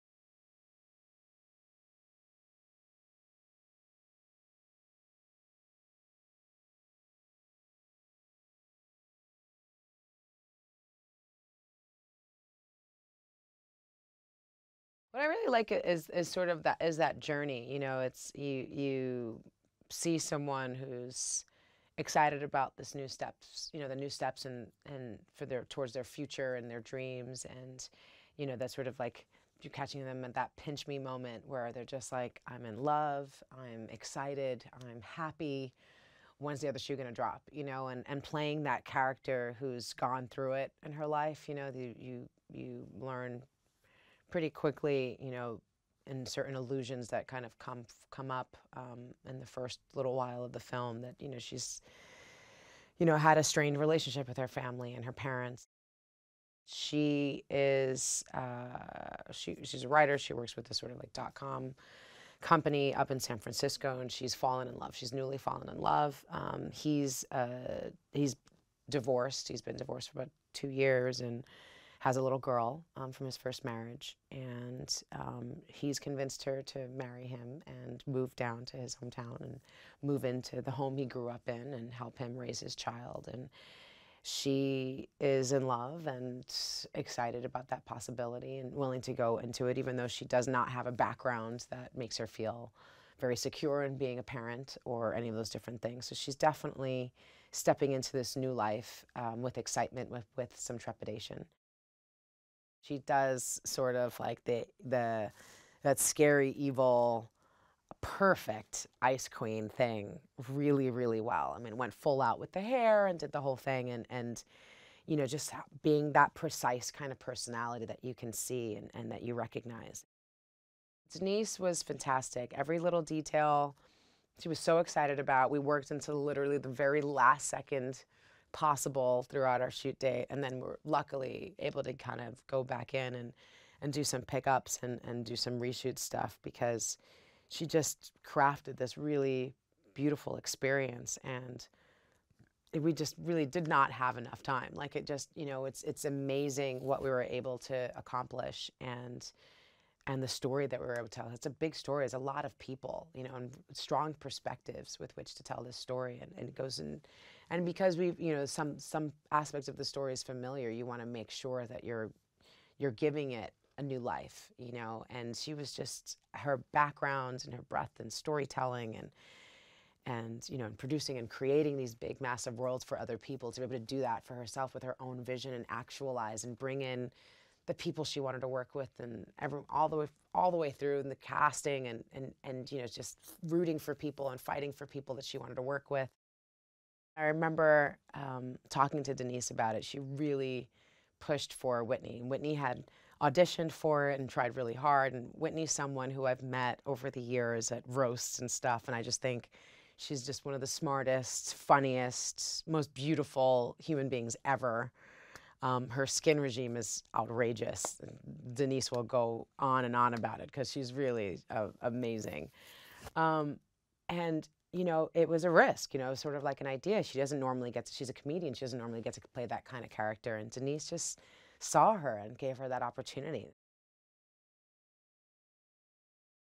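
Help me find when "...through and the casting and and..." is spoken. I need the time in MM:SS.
03:00.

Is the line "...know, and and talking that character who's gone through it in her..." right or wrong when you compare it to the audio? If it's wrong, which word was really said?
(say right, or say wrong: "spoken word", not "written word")
wrong: "playing", not "talking".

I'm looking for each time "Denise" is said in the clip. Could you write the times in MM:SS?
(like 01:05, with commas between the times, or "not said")
02:01, 03:09, 03:28, 03:40.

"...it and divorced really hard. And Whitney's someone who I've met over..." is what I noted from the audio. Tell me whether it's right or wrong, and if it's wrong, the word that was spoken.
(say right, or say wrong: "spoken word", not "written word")
wrong: "tried", not "divorced".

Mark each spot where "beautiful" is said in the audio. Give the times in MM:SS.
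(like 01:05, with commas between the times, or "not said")
02:19, 03:22.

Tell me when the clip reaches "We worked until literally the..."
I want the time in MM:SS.
02:05.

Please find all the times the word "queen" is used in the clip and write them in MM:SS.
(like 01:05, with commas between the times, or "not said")
01:49.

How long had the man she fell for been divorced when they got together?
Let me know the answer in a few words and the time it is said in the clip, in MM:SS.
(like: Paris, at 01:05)
About 2 years, at 01:10.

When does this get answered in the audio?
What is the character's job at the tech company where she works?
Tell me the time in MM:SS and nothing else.
00:59.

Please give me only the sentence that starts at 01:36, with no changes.
So she's definitely stepping into this new life um, with excitement, with, with some trepidation.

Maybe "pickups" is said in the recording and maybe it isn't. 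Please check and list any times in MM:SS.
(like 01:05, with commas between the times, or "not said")
02:14.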